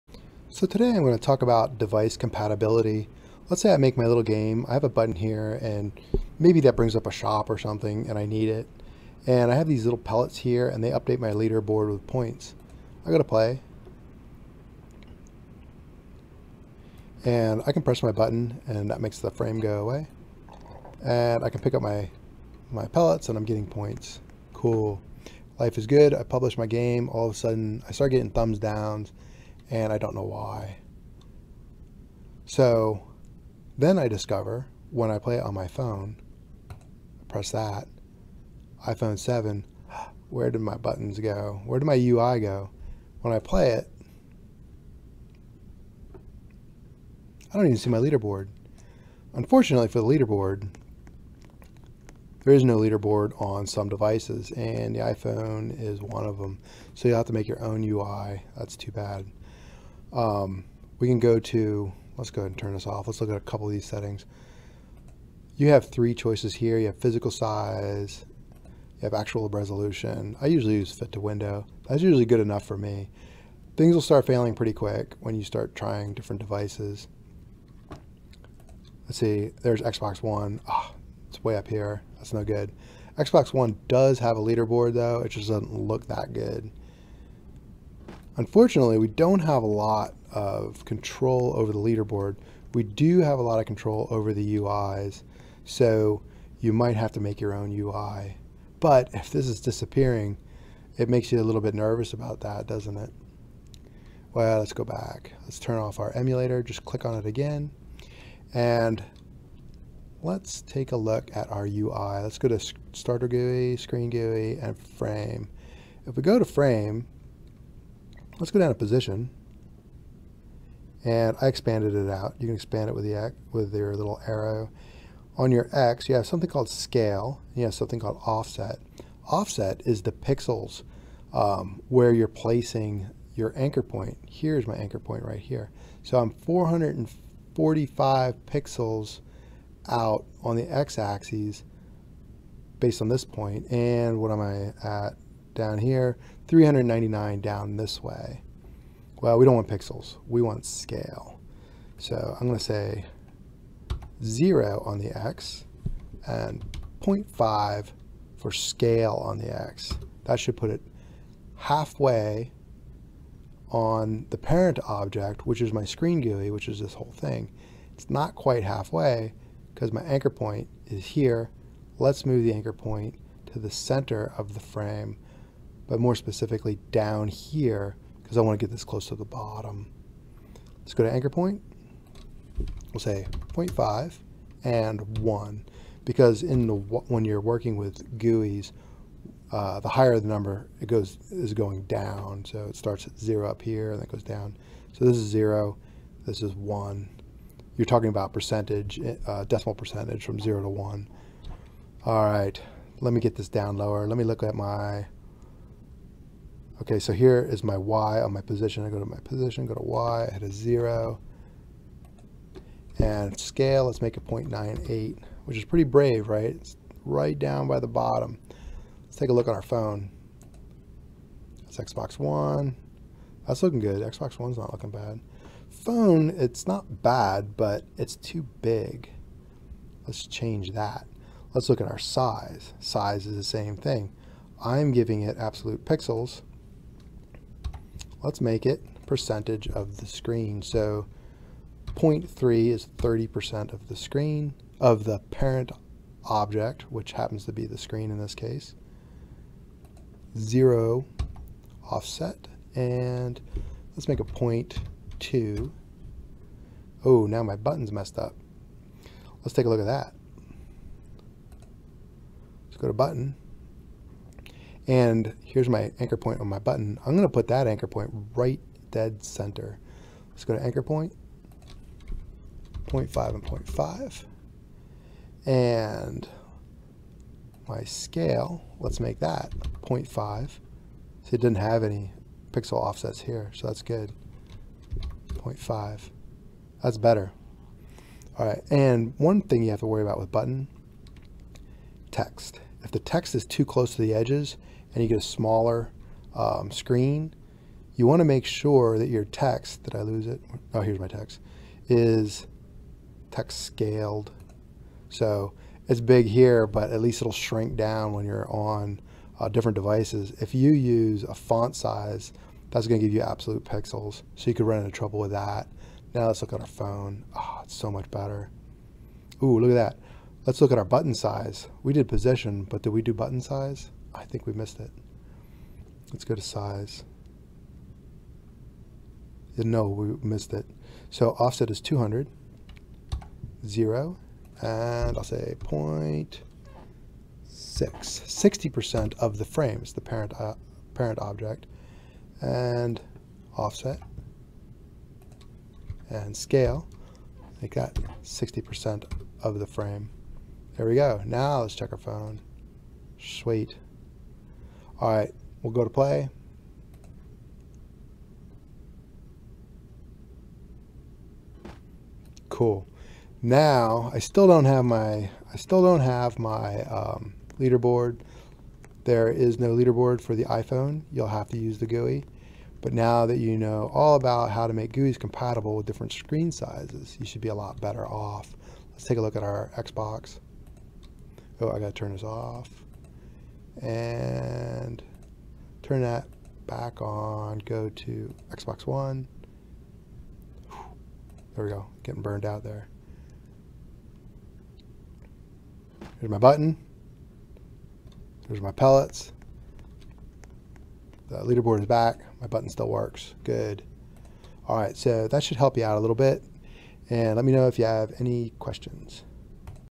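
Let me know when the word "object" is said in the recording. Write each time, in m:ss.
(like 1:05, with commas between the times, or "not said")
2:44, 4:06, 5:41.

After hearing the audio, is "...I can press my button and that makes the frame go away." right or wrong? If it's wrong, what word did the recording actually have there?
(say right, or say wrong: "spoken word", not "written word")
right.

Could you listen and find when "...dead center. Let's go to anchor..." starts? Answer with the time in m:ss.
4:28.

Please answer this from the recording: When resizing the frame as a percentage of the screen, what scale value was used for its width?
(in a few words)
0.3.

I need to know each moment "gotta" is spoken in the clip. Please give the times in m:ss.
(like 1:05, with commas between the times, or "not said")
6:21.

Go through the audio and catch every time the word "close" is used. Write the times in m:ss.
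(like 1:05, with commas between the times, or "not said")
2:58, 4:53.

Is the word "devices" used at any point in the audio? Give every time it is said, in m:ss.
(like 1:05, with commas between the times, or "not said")
0:01, 0:53, 1:16, 5:09.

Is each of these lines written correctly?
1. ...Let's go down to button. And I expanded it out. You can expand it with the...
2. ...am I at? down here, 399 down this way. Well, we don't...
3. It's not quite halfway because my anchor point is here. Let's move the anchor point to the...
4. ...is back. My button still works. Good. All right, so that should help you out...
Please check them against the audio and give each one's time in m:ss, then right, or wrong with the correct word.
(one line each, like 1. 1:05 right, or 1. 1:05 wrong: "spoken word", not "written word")
1. 1:58 wrong: "position", not "button"
2. 2:24 right
3. 2:47 right
4. 6:41 right.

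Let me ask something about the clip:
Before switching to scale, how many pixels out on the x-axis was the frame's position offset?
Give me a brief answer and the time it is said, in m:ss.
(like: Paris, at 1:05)
445, at 2:16.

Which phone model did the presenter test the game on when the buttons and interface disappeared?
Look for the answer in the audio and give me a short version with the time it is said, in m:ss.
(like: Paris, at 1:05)
iPhone 7, at 0:38.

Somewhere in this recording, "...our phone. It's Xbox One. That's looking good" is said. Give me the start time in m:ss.
3:39.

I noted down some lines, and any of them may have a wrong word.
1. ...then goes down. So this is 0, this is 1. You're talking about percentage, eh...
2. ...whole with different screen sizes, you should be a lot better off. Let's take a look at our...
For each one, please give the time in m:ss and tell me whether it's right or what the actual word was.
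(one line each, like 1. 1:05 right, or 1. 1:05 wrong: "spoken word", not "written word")
1. 3:13 right
2. 6:15 wrong: "compatible", not "whole".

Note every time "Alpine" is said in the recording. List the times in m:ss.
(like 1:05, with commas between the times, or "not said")
not said.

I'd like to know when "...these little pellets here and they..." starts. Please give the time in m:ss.
0:09.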